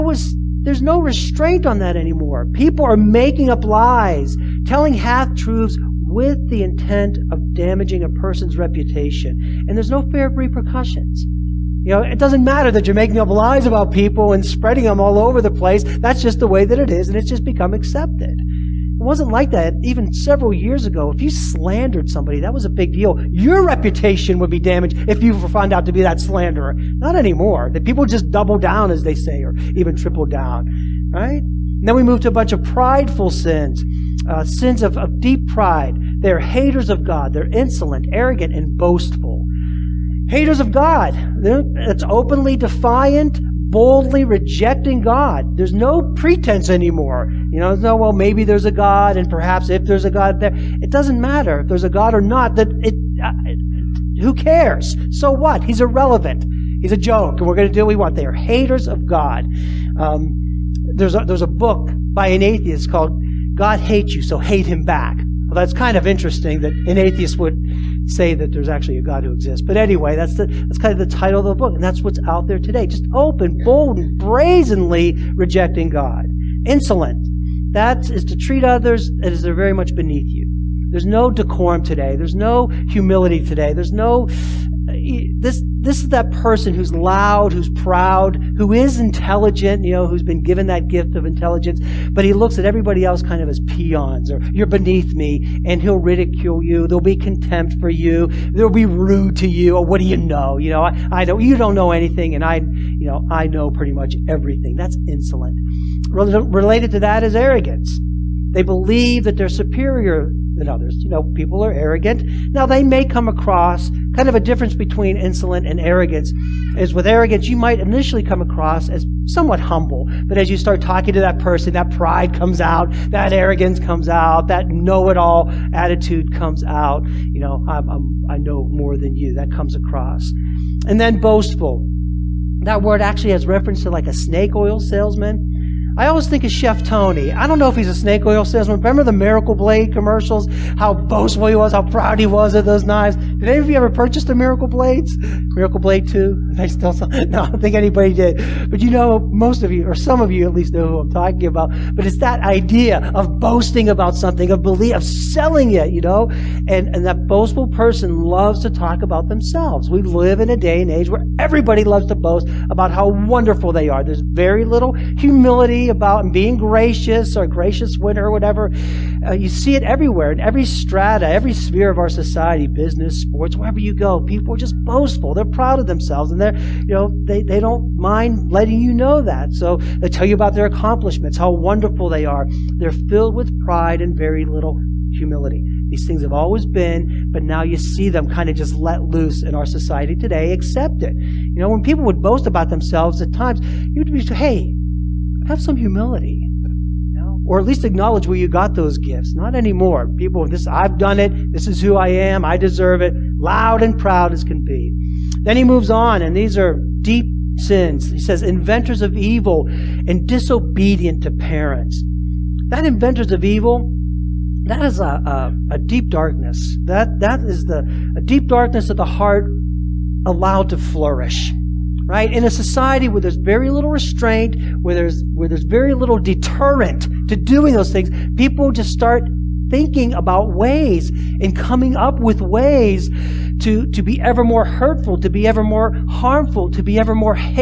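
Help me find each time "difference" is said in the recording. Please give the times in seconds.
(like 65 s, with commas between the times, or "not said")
114 s.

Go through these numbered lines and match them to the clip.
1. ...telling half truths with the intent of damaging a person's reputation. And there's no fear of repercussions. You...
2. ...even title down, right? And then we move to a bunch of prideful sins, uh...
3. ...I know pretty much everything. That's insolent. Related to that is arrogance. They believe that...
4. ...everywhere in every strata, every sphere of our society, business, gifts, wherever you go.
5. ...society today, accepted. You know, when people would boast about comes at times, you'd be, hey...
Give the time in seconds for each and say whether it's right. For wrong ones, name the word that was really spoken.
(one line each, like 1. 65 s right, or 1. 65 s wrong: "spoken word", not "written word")
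1. 4 s right
2. 29 s wrong: "triple", not "title"
3. 103 s right
4. 169 s wrong: "sports", not "gifts"
5. 189 s wrong: "themselves", not "comes".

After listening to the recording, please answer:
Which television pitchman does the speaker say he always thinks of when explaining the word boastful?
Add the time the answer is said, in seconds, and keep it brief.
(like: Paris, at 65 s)
Chef Tony, at 136 s.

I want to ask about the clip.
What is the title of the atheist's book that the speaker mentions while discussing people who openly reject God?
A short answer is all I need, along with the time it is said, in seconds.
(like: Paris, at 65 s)
God Hates You, So Hate Him Back, at 63 s.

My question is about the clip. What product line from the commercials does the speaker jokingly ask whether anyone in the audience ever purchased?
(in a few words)
Miracle Blades.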